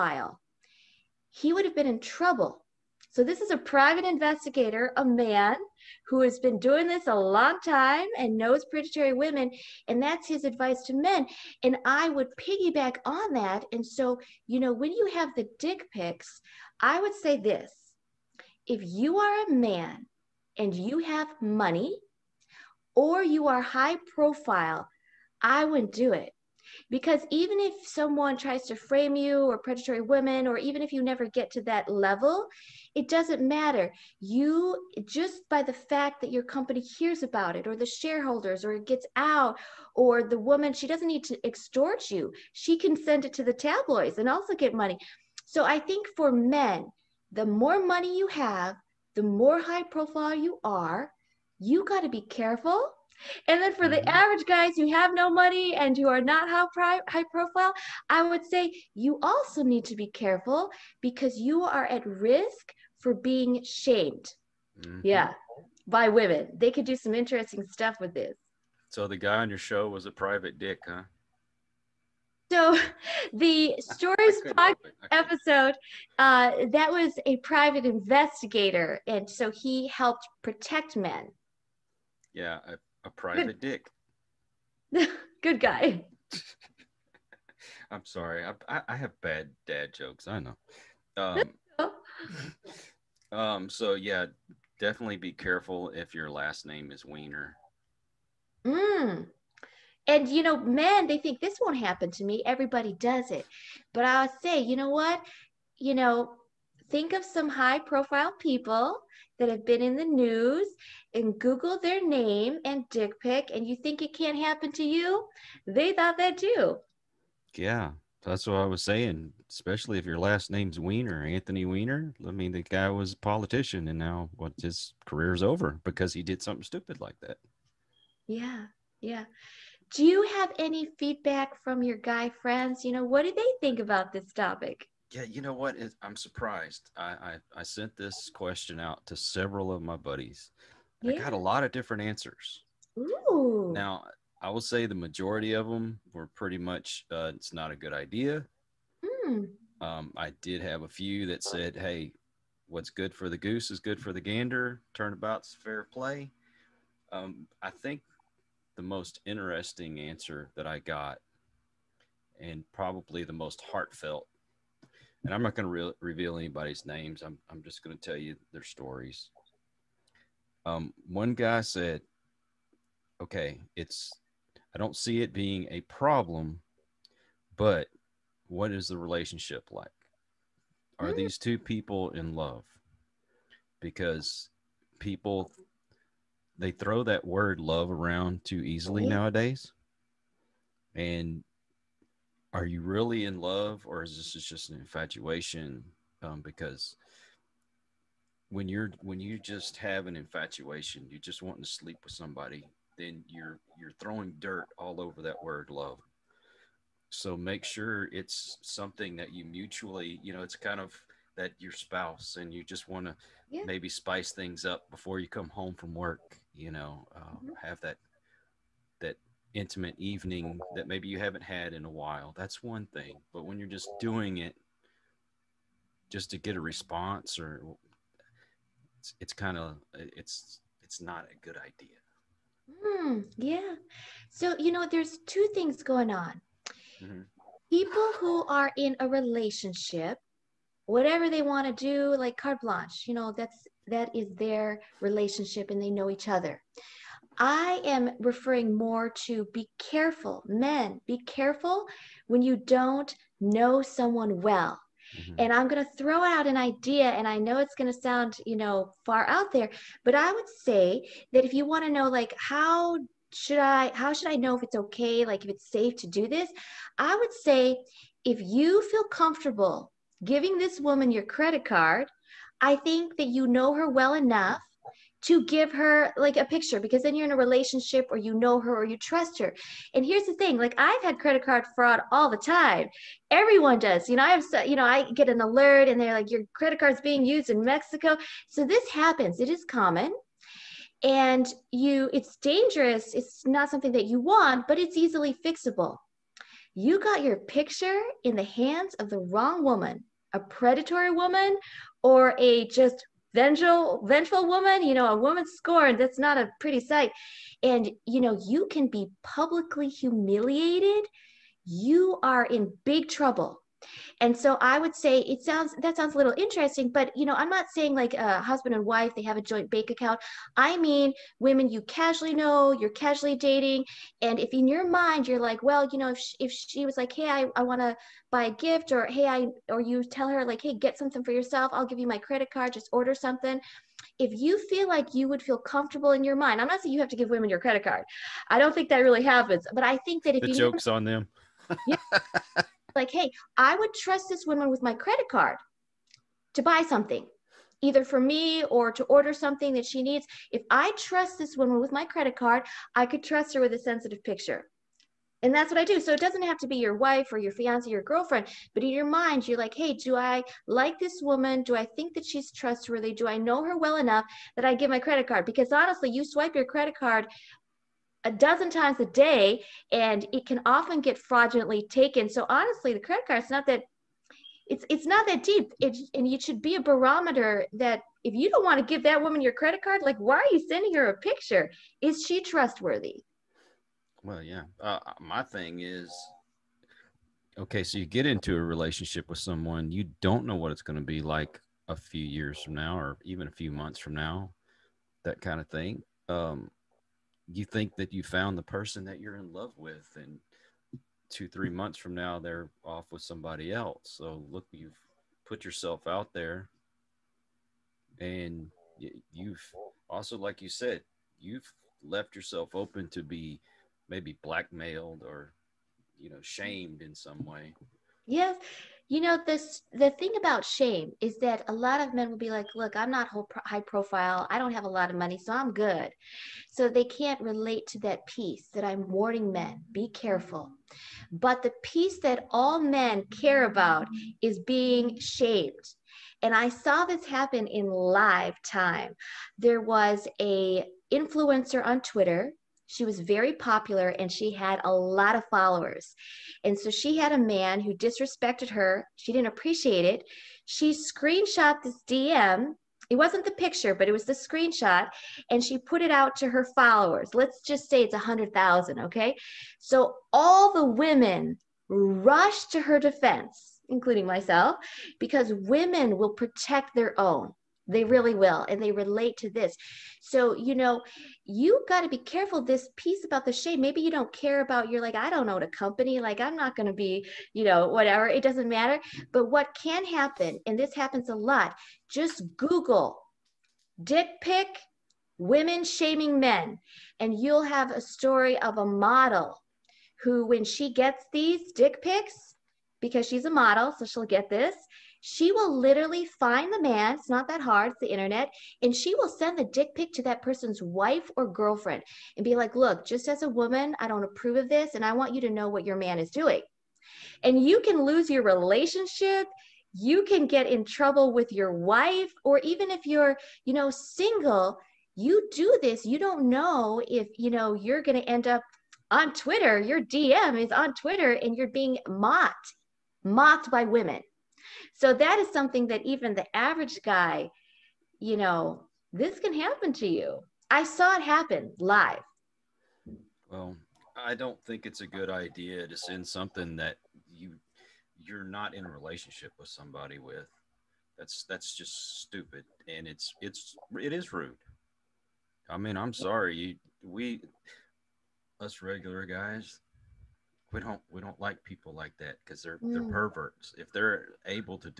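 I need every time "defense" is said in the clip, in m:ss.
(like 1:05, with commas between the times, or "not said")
7:42.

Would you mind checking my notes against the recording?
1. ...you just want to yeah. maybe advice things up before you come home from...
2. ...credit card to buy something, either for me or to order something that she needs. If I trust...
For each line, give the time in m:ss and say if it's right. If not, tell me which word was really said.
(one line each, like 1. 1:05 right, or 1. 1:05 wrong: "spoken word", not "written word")
1. 3:32 wrong: "spice", not "advice"
2. 5:44 right.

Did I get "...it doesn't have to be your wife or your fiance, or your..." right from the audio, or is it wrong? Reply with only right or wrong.
right.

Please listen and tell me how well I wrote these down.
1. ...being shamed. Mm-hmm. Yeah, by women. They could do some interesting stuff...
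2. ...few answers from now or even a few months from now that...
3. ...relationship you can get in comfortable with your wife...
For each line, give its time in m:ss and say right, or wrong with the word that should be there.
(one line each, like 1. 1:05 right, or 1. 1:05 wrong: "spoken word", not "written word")
1. 1:03 right
2. 6:31 wrong: "years", not "answers"
3. 8:28 wrong: "trouble", not "comfortable".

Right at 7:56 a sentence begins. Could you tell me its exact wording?
Like, I'm not going to be, you know, whatever.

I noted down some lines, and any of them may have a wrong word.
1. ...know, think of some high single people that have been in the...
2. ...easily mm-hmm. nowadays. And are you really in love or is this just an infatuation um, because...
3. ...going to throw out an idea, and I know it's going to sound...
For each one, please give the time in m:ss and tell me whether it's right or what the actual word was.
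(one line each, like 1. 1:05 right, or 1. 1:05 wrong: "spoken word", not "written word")
1. 1:45 wrong: "profile", not "single"
2. 3:08 right
3. 4:15 right.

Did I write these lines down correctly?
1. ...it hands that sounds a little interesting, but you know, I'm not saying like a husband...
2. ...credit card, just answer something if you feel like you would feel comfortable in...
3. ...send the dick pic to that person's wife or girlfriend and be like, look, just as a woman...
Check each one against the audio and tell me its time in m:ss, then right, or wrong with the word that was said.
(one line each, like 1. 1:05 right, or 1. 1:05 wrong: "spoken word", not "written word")
1. 5:15 wrong: "sounds", not "hands"
2. 5:32 wrong: "order", not "answer"
3. 8:19 right.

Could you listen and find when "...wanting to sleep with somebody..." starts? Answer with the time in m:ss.
3:21.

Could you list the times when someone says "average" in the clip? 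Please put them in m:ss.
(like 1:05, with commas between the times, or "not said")
0:54, 8:46.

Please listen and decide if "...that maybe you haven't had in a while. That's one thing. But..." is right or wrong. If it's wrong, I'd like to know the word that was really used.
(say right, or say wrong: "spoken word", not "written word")
right.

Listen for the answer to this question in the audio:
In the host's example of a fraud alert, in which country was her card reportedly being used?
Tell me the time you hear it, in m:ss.
4:47.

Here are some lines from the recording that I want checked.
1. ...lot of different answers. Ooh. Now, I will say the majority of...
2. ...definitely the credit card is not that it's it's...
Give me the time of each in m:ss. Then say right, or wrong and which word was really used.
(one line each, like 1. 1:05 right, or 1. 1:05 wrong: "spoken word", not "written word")
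1. 2:21 right
2. 6:12 wrong: "honestly", not "definitely".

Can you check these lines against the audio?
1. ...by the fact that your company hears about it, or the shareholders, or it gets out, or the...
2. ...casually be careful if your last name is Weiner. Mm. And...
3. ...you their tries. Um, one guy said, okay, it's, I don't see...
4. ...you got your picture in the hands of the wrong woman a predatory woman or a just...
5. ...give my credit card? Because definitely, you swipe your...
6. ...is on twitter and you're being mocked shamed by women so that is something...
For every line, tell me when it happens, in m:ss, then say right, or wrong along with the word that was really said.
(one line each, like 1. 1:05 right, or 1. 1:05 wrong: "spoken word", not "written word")
1. 0:35 right
2. 1:34 wrong: "definitely", not "casually"
3. 2:48 wrong: "stories", not "tries"
4. 4:56 right
5. 6:04 wrong: "honestly", not "definitely"
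6. 8:40 wrong: "mocked", not "shamed".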